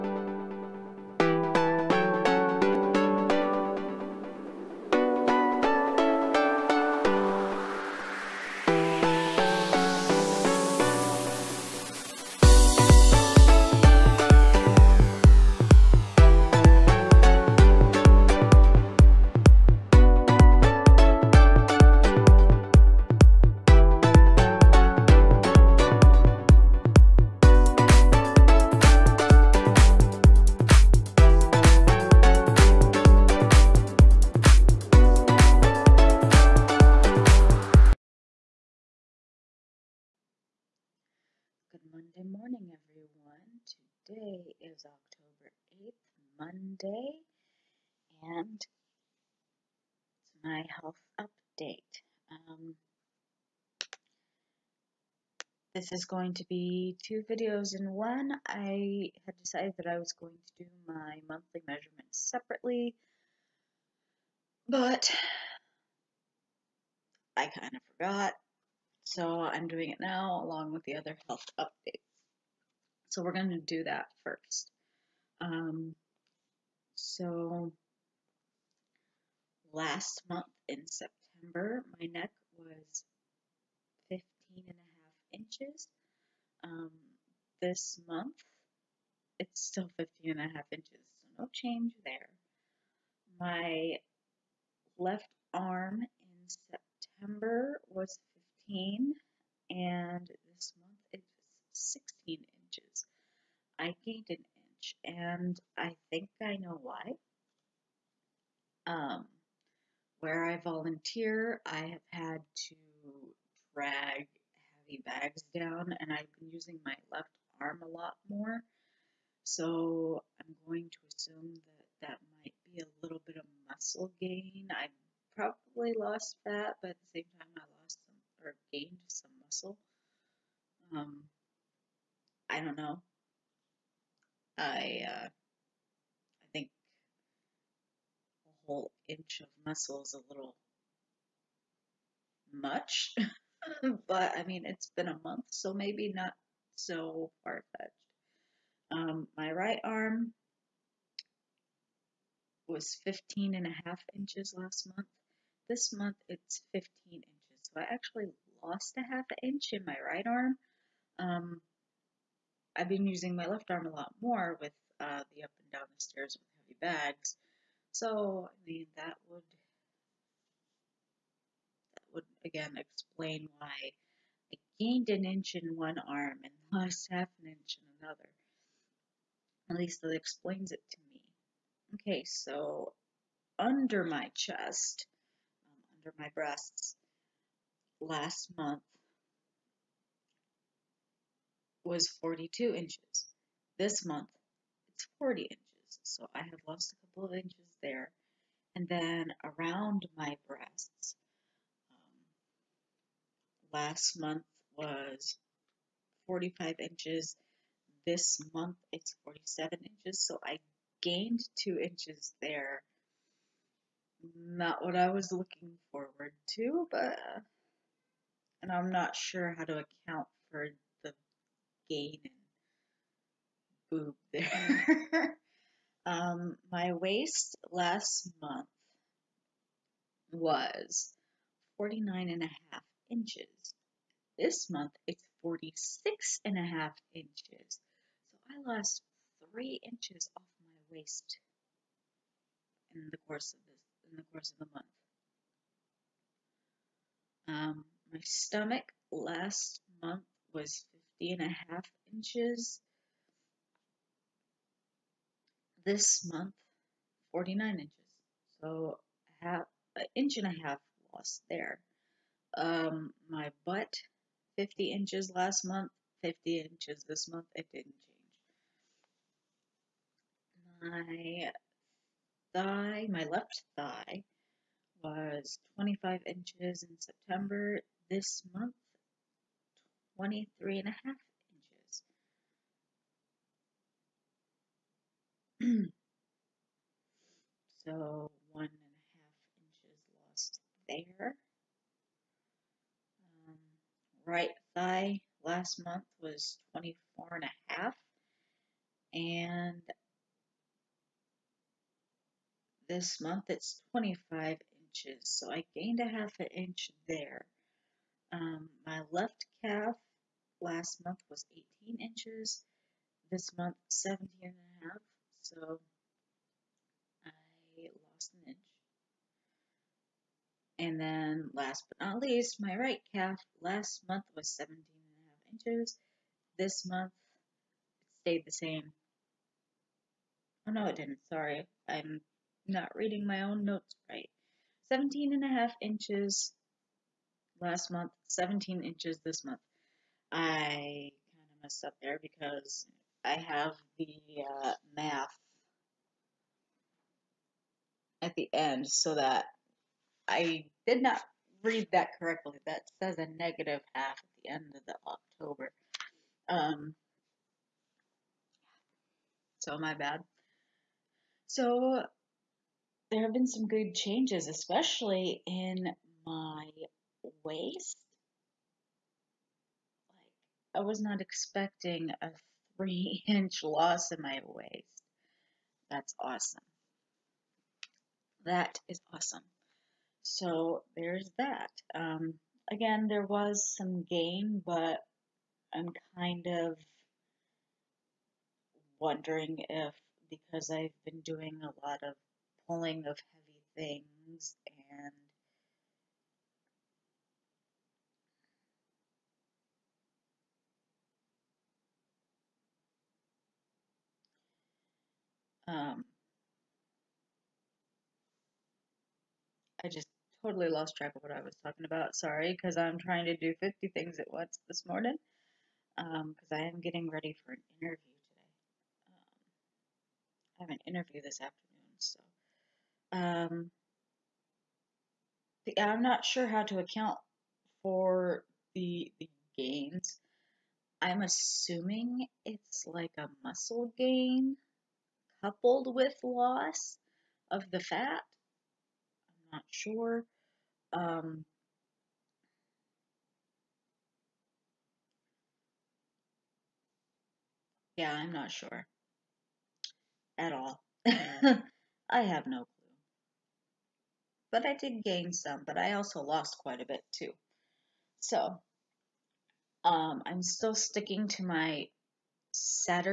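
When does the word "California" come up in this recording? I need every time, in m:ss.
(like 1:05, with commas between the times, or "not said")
not said.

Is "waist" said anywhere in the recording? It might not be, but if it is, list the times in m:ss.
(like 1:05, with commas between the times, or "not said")
3:46, 4:00, 6:07, 6:14.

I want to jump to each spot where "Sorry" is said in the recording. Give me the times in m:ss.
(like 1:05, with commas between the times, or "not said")
5:31, 6:52.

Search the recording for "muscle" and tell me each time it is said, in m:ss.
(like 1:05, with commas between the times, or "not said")
2:03, 2:09, 2:19, 7:13.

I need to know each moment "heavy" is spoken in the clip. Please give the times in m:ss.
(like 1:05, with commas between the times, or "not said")
1:54, 2:46, 6:33.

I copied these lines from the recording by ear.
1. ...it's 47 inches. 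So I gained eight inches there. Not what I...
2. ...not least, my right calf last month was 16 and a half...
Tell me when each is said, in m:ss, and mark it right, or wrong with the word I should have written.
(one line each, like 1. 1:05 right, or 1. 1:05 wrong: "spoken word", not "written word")
1. 3:28 wrong: "two", not "eight"
2. 5:22 wrong: "17", not "16".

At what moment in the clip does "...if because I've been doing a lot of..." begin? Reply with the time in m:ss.
6:29.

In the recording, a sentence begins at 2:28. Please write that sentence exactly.
Um, my right arm was 15 and a half inches last month.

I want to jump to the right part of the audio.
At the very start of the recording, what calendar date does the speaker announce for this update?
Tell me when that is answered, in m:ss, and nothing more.
0:44.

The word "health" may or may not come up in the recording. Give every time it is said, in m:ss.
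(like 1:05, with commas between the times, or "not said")
0:50, 1:11.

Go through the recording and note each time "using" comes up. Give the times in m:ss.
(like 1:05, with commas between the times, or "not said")
1:56, 2:43.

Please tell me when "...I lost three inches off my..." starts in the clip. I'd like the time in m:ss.
3:58.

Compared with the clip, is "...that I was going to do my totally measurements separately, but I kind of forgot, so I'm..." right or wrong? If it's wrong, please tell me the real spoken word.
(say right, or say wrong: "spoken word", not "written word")
wrong: "monthly", not "totally".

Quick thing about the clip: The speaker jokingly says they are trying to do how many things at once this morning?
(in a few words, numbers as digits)
50 things.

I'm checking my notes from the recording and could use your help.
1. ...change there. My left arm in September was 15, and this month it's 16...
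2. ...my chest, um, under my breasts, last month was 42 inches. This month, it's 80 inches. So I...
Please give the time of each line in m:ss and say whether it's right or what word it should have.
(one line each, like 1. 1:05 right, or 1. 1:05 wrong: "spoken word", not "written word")
1. 1:31 right
2. 3:04 wrong: "40", not "80".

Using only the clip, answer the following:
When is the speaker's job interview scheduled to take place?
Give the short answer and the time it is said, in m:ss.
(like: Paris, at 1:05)
this afternoon, at 7:01.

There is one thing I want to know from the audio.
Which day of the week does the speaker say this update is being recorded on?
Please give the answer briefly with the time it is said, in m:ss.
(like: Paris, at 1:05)
Monday, at 0:46.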